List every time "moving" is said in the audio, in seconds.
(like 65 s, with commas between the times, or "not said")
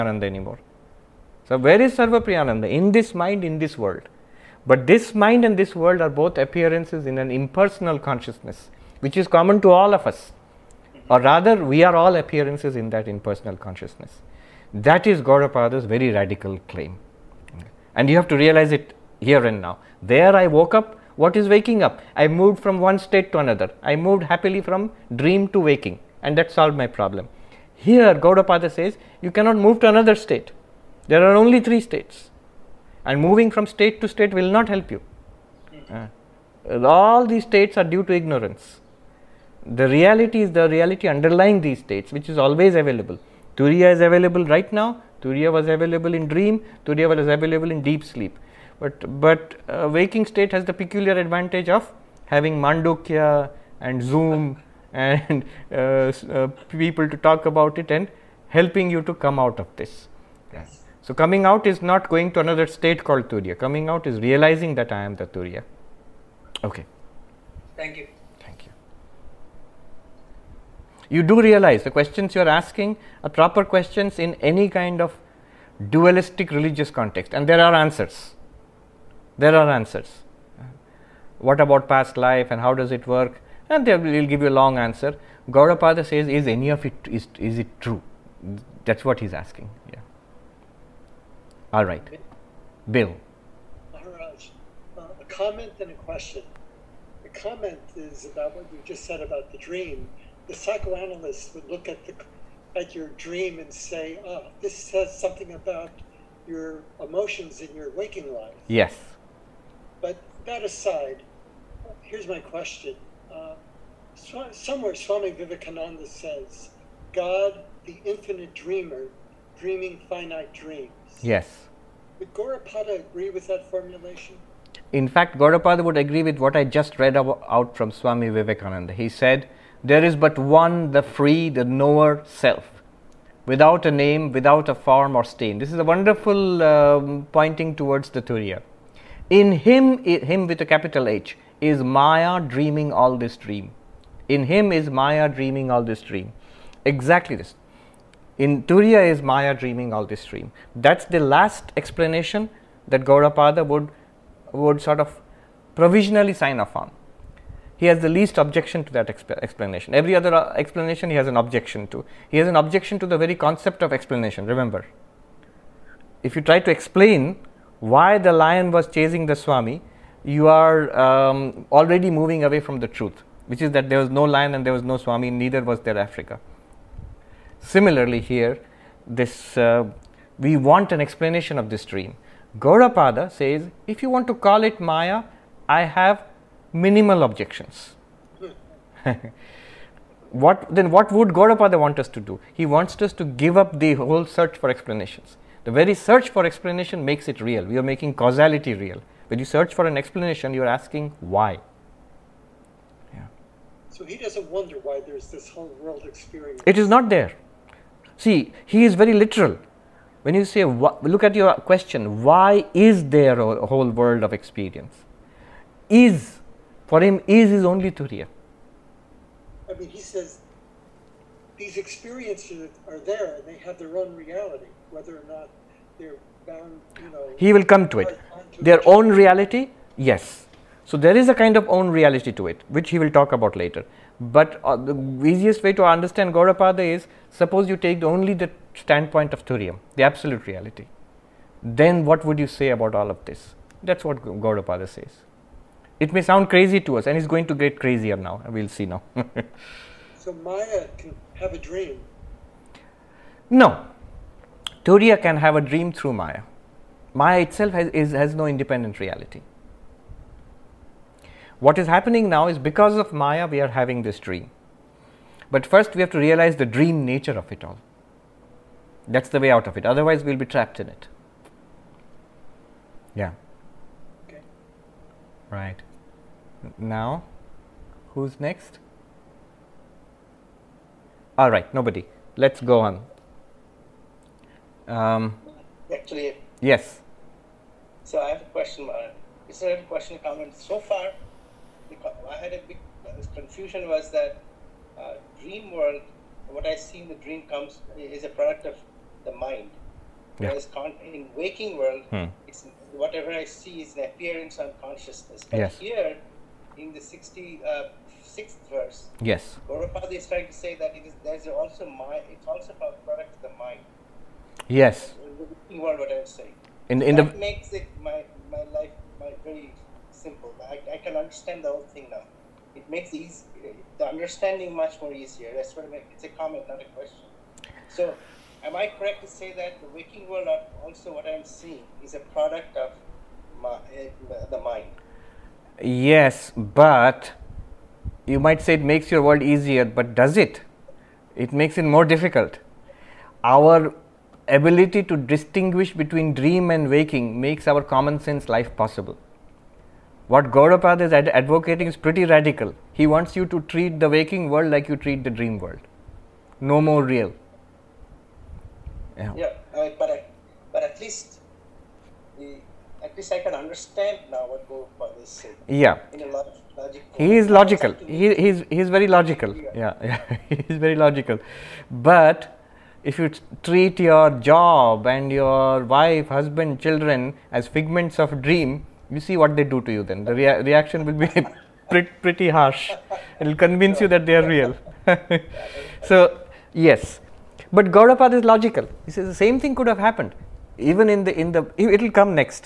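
33 s, 172 s.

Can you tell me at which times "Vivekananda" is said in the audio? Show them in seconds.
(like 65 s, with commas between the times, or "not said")
115 s, 128 s.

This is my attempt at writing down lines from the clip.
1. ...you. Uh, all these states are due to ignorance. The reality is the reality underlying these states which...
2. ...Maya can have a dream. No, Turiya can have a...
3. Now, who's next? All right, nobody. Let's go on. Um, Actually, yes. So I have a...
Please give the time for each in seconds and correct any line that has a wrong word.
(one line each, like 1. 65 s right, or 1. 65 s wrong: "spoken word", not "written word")
1. 34 s right
2. 250 s right
3. 276 s right.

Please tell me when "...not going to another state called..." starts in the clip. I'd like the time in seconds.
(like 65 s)
61 s.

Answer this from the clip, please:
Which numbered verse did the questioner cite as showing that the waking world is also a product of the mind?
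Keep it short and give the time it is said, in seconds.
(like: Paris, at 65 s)
66th, at 306 s.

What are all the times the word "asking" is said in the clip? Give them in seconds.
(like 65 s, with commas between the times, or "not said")
72 s, 89 s, 200 s.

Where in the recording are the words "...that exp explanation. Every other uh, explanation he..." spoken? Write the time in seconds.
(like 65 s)
158 s.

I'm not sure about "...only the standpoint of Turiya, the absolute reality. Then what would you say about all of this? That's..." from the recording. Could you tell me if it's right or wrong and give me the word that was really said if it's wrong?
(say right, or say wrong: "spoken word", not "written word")
right.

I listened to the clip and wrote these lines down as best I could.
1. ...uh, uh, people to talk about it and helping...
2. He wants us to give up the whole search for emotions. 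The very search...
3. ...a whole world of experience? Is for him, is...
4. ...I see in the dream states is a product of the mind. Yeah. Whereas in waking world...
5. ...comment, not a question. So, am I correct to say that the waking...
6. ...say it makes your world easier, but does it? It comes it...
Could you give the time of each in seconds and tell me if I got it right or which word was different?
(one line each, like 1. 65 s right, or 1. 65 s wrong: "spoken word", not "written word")
1. 55 s right
2. 192 s wrong: "explanations", not "emotions"
3. 213 s right
4. 296 s wrong: "comes", not "states"
5. 326 s right
6. 338 s wrong: "makes", not "comes".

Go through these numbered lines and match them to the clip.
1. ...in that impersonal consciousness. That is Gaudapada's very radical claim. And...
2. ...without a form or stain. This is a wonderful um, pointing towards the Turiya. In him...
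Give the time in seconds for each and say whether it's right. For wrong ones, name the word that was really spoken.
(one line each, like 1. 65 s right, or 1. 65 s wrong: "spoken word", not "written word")
1. 12 s right
2. 134 s right.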